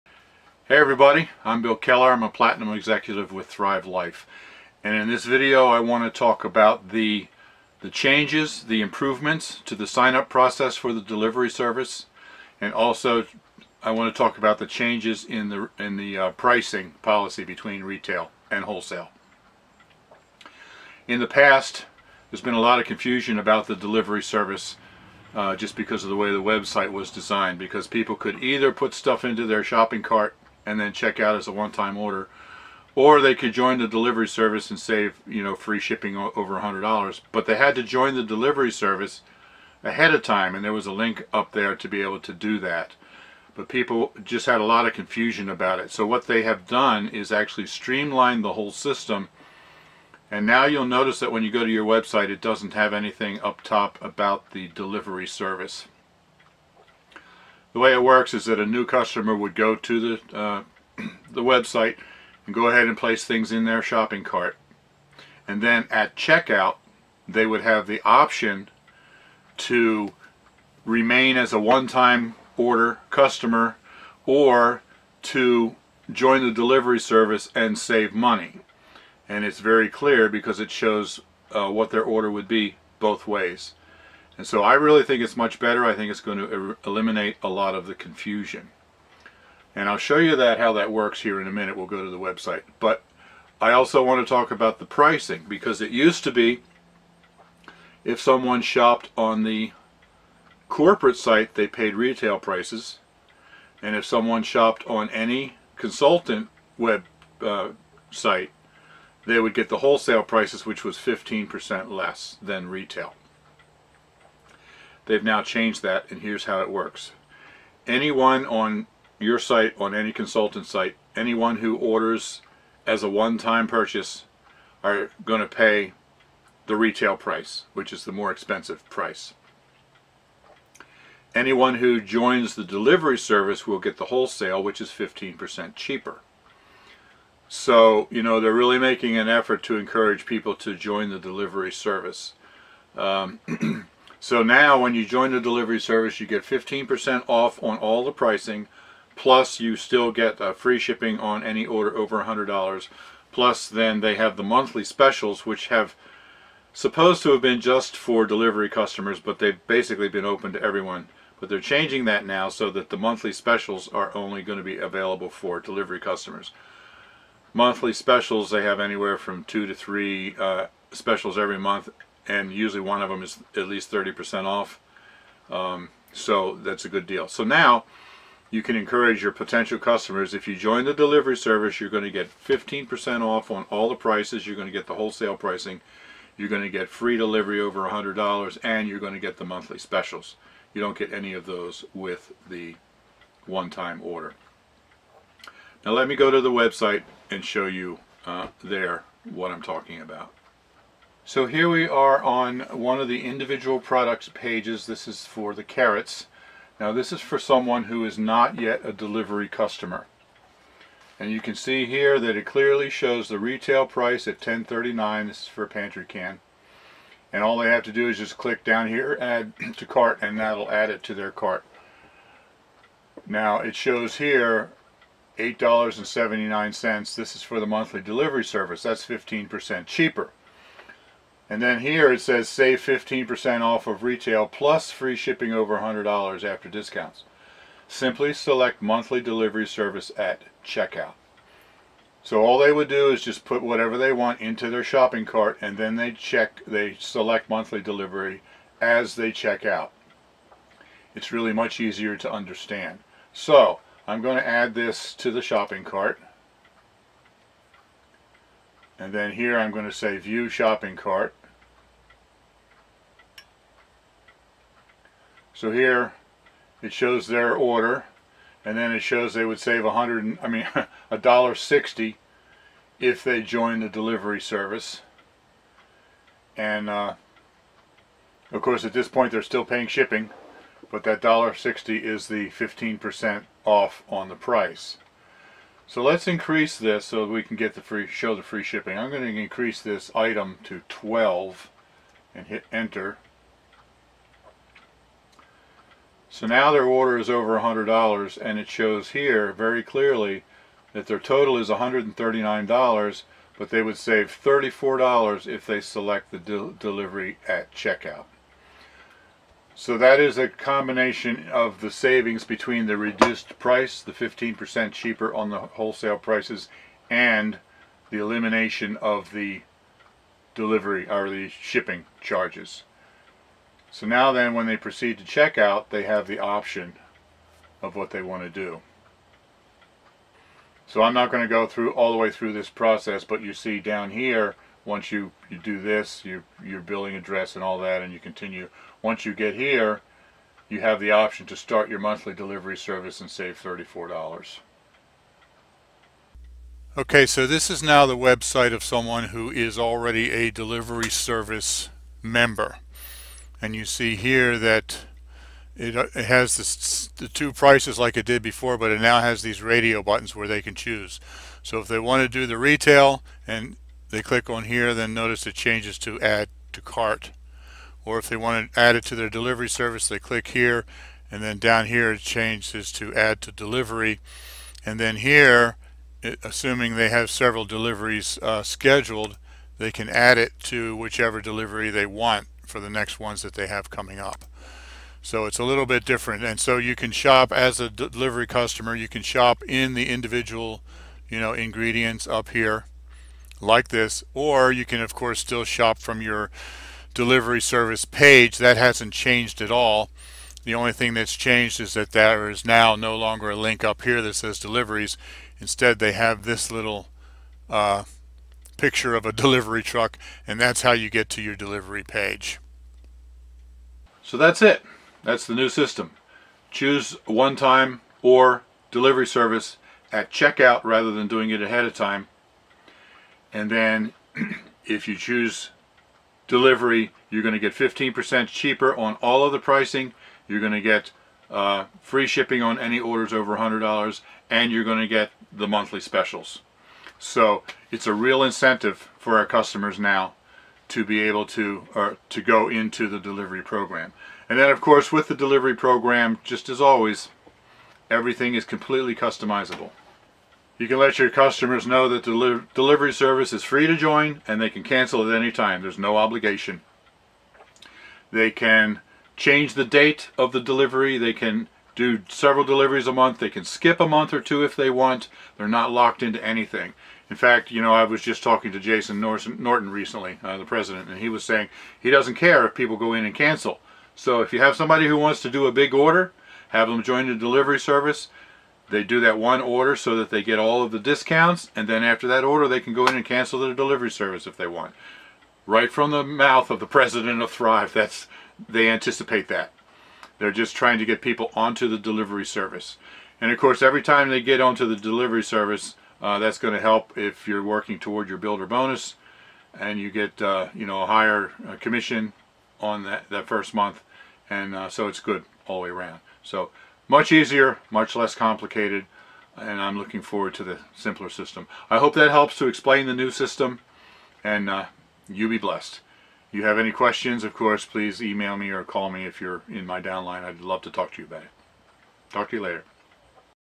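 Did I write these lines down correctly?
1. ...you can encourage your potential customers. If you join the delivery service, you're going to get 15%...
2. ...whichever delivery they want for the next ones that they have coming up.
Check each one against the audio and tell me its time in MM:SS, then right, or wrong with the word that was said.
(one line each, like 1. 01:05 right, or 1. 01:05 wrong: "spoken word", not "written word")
1. 02:58 right
2. 06:20 right.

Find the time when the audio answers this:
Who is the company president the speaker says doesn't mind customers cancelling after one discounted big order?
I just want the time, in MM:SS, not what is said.
07:48.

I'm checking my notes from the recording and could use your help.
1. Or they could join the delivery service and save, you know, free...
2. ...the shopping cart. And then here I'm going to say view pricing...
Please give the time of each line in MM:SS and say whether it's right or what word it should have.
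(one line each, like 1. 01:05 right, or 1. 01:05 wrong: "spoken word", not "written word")
1. 00:32 right
2. 04:15 wrong: "shopping", not "pricing".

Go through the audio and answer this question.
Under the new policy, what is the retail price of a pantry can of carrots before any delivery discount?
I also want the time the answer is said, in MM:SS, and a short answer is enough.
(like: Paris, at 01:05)
10.39, at 03:34.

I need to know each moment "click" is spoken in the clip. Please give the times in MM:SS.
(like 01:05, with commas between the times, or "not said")
03:38, 06:04, 06:10.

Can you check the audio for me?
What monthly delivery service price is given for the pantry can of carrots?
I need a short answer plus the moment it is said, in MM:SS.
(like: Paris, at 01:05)
$8.79, at 03:45.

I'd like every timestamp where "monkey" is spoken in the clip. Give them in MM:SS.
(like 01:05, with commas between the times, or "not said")
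not said.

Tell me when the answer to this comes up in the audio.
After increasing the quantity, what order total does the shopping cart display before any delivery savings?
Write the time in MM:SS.
05:01.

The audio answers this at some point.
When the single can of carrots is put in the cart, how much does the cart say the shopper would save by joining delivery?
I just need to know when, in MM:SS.
04:31.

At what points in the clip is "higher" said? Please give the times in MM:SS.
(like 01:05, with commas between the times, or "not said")
08:21.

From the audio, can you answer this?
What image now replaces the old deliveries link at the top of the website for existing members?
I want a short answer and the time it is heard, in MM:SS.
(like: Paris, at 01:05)
delivery truck, at 06:49.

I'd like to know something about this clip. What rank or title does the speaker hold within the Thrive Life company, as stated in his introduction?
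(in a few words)
Platinum Executive.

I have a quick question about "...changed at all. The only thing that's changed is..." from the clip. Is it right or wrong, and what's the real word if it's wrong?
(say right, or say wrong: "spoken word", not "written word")
right.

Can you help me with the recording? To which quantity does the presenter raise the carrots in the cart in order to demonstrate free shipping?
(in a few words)
12.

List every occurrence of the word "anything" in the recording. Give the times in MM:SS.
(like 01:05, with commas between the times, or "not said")
00:52, 07:46.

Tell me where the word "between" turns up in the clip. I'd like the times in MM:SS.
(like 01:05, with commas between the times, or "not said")
00:17, 05:12.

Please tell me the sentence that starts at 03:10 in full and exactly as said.
You don't get any of those with the one-time order.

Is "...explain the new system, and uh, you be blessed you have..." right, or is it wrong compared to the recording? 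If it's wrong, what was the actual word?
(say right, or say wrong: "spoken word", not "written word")
right.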